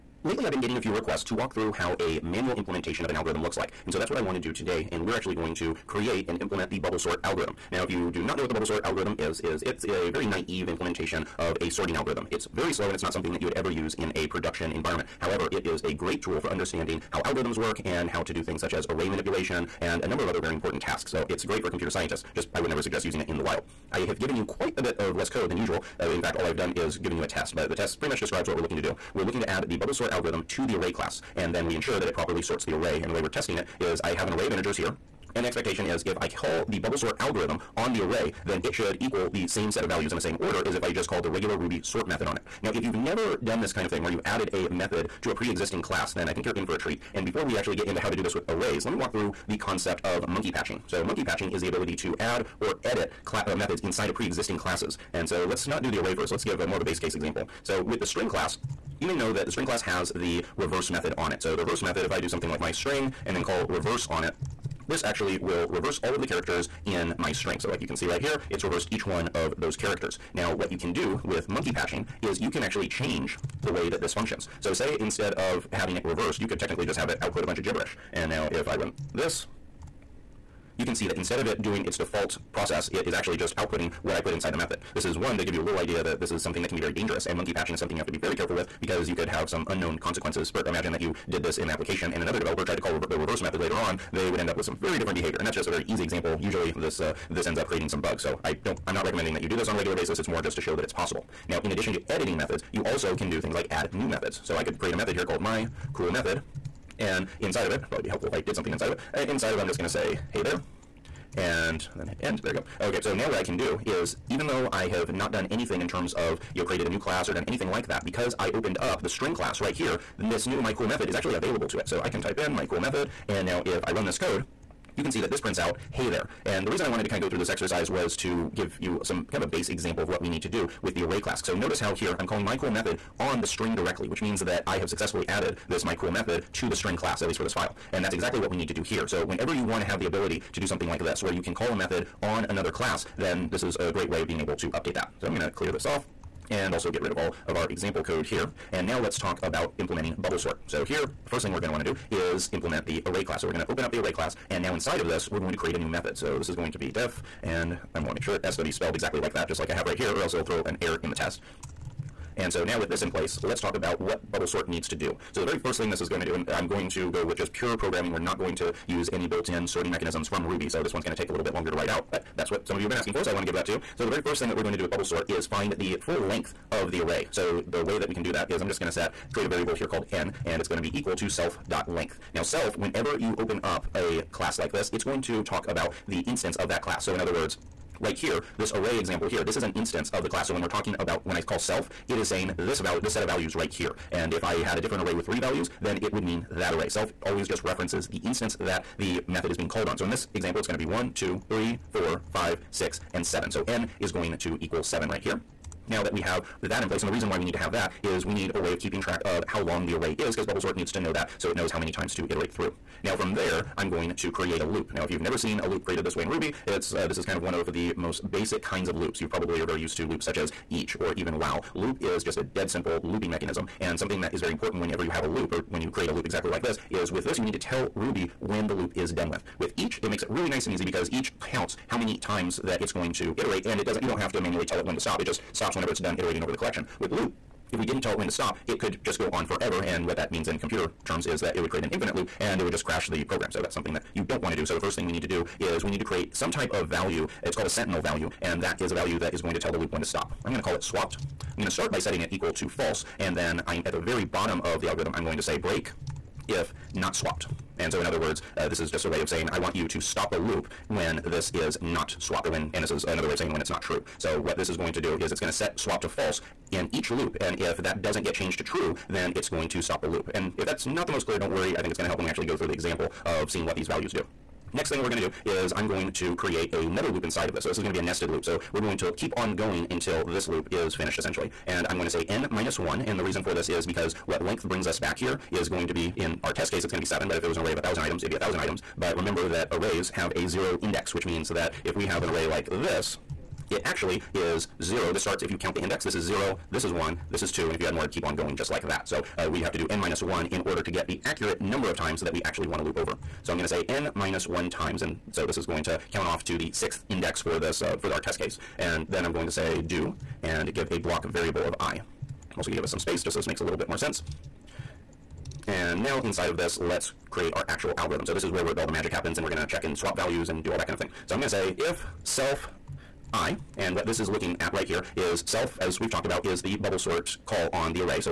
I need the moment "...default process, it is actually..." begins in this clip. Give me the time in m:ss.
1:21.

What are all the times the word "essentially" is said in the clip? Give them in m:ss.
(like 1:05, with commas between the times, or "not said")
4:41.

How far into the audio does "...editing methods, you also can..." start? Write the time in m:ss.
1:42.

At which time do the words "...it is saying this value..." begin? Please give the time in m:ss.
3:12.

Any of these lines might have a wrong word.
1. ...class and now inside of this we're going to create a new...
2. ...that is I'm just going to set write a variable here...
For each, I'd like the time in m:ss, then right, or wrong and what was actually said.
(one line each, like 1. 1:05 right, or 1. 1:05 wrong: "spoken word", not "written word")
1. 2:34 right
2. 2:58 wrong: "create", not "write".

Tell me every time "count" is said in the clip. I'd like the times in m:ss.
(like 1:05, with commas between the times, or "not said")
3:51, 4:55, 5:06.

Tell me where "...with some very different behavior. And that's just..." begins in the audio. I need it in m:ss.
1:34.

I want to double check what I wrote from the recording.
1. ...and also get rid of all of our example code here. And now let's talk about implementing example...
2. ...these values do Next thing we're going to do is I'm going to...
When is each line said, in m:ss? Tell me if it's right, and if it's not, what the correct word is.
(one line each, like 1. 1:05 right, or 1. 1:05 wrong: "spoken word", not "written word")
1. 2:26 wrong: "bubble", not "example"
2. 4:33 right.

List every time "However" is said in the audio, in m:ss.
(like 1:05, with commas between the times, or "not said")
0:15.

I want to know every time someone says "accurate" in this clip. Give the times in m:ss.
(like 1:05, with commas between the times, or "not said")
5:01.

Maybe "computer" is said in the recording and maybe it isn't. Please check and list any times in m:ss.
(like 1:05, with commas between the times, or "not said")
0:21, 4:00.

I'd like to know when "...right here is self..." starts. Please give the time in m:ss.
5:24.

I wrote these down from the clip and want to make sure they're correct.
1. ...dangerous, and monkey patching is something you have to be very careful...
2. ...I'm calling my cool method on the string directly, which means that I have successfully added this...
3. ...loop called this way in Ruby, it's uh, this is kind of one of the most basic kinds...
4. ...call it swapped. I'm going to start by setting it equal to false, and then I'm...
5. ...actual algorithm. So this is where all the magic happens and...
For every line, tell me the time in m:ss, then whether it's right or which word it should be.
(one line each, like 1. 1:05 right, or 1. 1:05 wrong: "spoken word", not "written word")
1. 1:26 right
2. 2:12 right
3. 3:35 wrong: "created", not "called"
4. 4:10 right
5. 5:17 right.